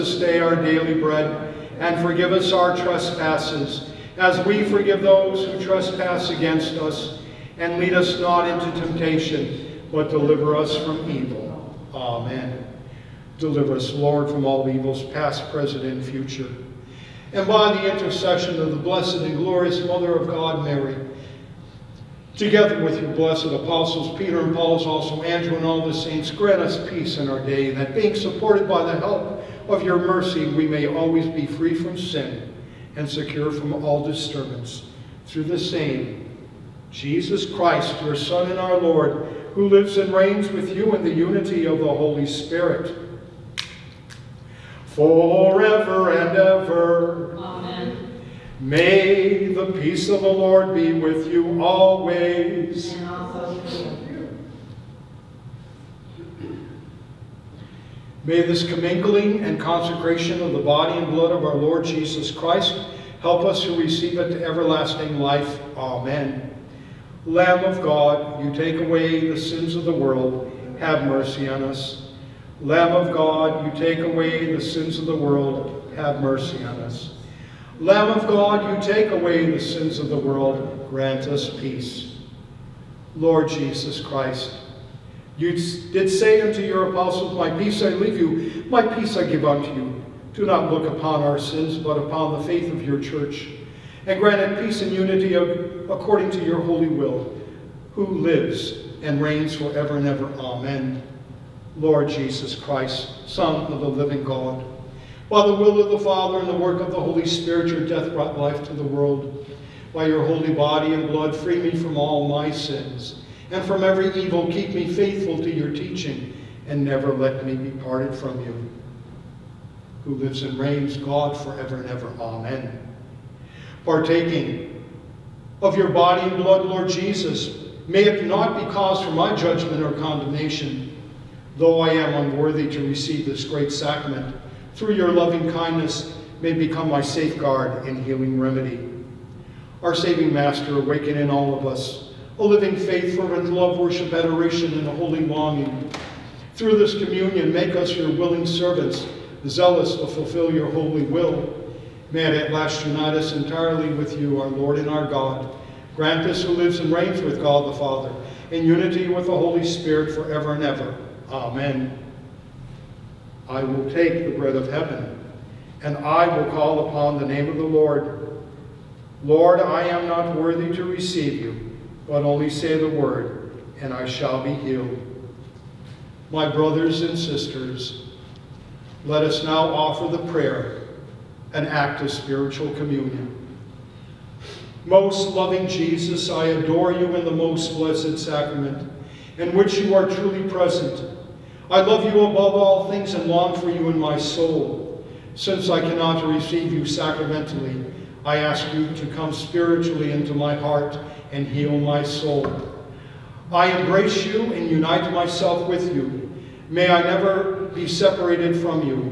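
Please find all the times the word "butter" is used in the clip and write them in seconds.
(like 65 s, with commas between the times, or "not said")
not said.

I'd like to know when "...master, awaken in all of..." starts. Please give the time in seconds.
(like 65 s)
140 s.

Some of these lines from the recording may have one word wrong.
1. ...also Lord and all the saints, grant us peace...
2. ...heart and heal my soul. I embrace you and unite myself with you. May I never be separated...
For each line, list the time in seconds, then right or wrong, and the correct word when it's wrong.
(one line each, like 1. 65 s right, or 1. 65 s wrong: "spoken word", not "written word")
1. 24 s wrong: "Andrew", not "Lord"
2. 200 s right.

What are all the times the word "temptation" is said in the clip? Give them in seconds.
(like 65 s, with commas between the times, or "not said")
8 s.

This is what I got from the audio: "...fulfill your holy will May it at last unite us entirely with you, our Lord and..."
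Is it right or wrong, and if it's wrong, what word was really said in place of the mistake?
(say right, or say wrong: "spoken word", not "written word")
right.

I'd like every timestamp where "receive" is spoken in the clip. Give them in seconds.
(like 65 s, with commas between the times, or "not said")
63 s, 132 s, 170 s, 196 s.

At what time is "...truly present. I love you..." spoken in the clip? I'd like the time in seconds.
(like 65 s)
190 s.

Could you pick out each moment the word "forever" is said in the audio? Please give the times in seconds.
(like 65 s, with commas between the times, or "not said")
44 s, 99 s, 121 s, 160 s.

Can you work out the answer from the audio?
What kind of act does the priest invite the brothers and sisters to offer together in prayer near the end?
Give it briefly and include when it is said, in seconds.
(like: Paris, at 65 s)
spiritual communion, at 182 s.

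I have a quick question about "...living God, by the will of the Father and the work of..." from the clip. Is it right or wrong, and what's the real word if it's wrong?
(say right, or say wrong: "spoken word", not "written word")
right.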